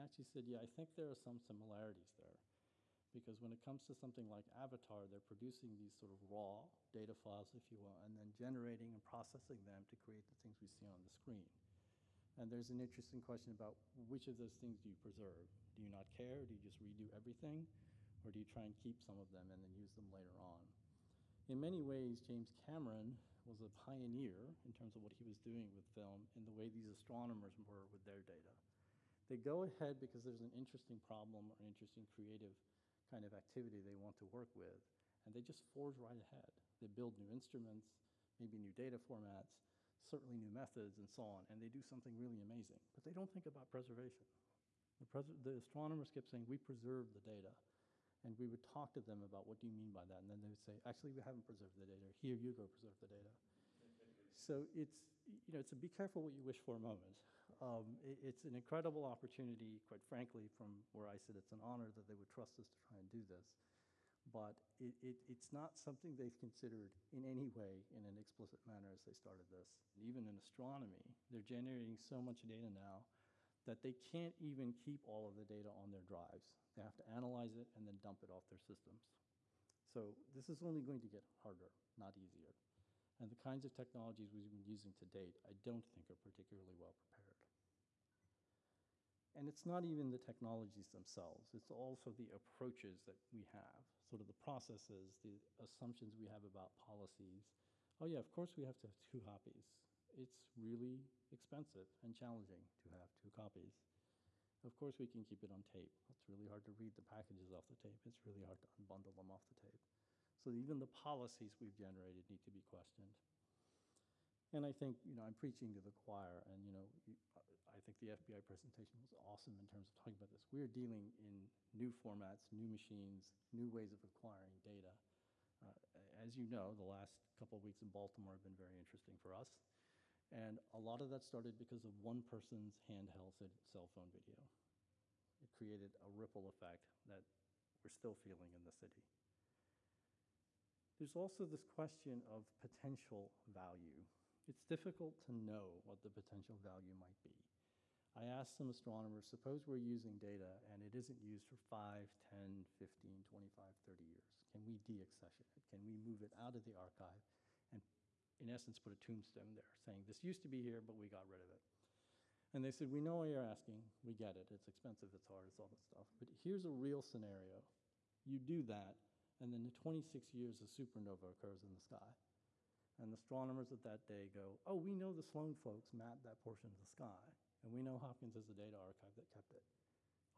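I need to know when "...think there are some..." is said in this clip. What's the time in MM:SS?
00:00.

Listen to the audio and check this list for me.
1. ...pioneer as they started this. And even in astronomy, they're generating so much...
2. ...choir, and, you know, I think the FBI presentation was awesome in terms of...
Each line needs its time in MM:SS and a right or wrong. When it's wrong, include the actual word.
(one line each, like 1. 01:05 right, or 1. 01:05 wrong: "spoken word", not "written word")
1. 01:08 wrong: "manner", not "pioneer"
2. 01:55 right.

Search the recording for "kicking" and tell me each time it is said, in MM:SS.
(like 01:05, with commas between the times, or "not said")
not said.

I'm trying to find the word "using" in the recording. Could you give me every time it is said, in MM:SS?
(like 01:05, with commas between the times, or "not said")
01:24, 02:29.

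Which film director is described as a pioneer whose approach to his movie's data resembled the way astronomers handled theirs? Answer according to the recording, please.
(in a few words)
James Cameron.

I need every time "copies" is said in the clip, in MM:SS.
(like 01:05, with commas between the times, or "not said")
01:39, 01:43.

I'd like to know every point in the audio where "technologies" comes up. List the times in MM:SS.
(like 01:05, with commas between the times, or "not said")
01:23, 01:30.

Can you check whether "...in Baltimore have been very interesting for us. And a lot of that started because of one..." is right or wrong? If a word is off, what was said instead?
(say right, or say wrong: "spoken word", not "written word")
right.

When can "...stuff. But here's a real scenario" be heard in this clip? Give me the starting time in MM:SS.
02:45.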